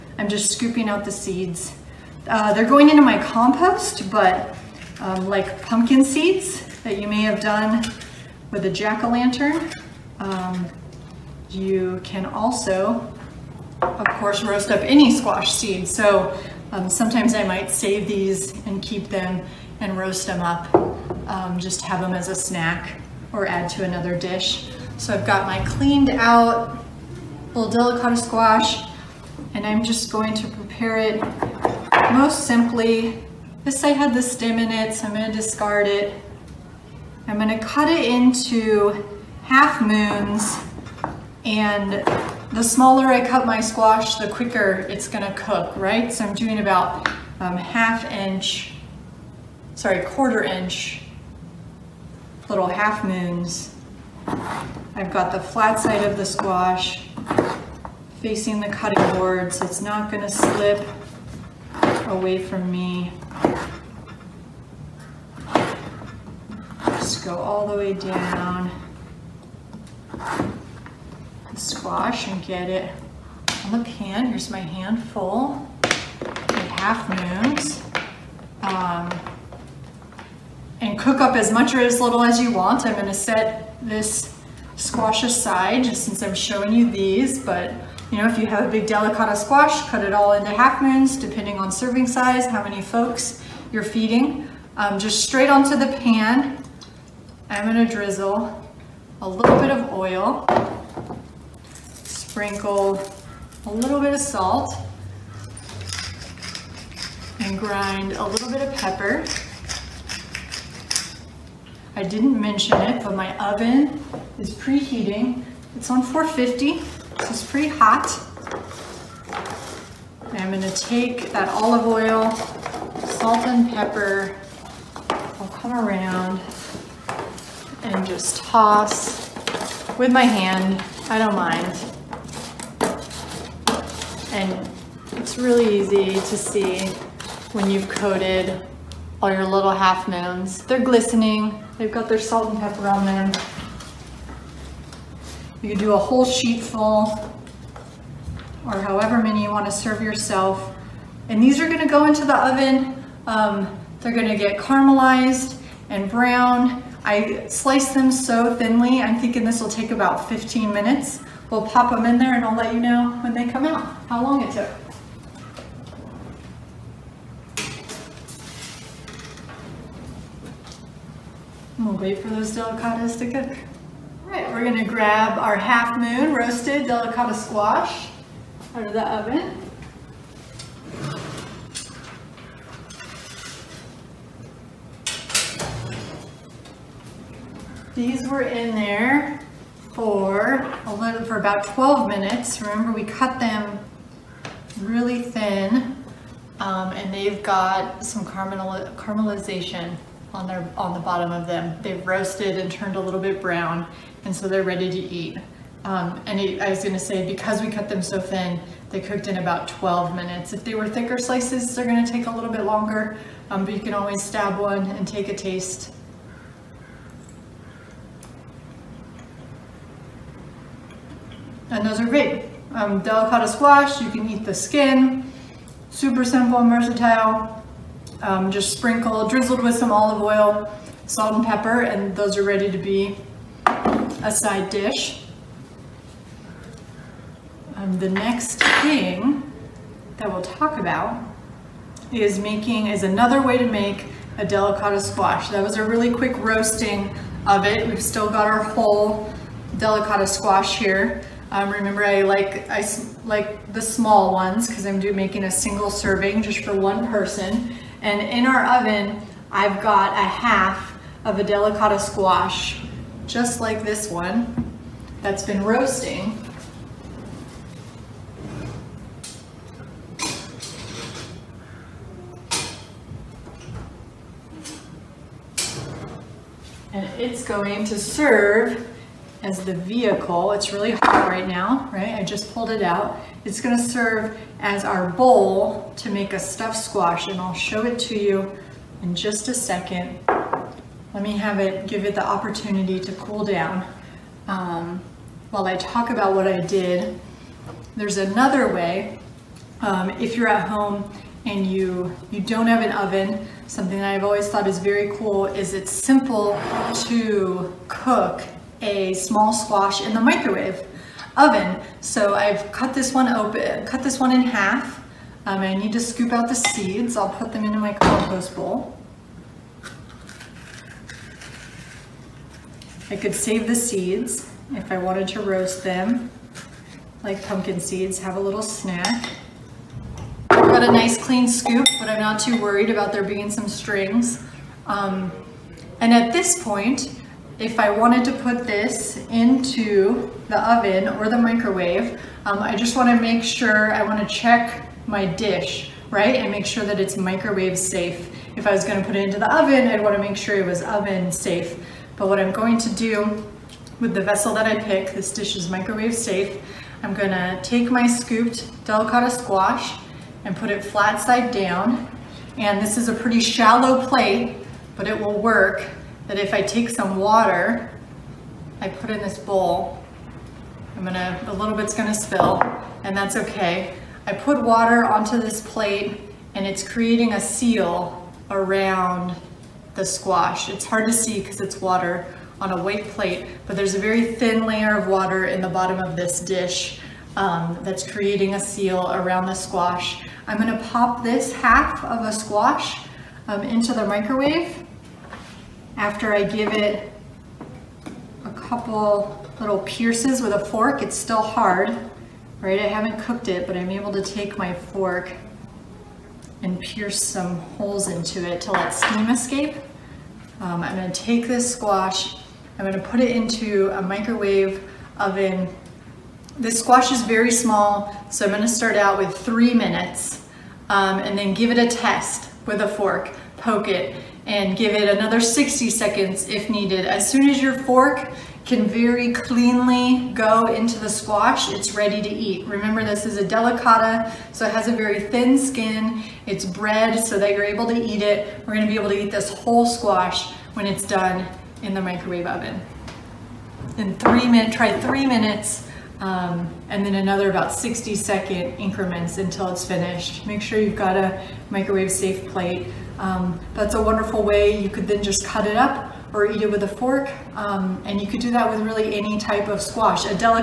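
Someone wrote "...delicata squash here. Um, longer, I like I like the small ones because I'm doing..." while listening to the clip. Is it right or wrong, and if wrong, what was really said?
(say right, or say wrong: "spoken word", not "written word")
wrong: "remember", not "longer".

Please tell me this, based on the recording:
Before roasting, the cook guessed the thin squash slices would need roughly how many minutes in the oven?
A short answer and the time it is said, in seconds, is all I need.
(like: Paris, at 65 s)
15 minutes, at 160 s.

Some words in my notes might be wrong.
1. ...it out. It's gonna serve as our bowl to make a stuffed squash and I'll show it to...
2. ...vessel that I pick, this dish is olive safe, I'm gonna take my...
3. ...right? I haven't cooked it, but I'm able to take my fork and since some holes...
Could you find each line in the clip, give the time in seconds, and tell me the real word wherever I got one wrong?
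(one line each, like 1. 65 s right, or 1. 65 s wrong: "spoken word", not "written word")
1. 282 s right
2. 354 s wrong: "microwave", not "olive"
3. 402 s wrong: "pierce", not "since".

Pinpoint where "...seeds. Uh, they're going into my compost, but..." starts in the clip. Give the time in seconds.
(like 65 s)
1 s.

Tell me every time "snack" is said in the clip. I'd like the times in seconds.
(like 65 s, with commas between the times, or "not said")
22 s, 328 s.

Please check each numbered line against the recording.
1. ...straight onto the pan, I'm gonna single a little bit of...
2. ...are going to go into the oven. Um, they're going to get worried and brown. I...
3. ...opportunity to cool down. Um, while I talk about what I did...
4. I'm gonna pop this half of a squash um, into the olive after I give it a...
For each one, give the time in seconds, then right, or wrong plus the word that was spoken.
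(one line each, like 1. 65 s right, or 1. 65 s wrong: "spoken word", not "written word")
1. 95 s wrong: "drizzle", not "single"
2. 151 s wrong: "caramelized", not "worried"
3. 292 s right
4. 390 s wrong: "microwave", not "olive".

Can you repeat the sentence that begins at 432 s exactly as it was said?
Remember this is a delicata, so it has a very thin skin.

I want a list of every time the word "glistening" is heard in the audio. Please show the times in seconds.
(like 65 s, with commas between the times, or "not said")
140 s.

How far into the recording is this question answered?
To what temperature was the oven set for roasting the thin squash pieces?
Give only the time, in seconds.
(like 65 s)
116 s.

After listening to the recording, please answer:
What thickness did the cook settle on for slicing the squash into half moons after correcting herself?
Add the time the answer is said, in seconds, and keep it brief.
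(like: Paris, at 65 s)
quarter inch, at 50 s.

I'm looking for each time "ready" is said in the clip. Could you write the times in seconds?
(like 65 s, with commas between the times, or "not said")
204 s, 232 s, 431 s.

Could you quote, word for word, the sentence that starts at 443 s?
In three minutes, try three minutes, um, and then another about 60 second increments until it's finished.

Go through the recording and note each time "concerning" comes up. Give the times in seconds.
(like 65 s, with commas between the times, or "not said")
not said.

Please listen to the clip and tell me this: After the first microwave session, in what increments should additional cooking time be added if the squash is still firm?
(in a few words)
60 seconds.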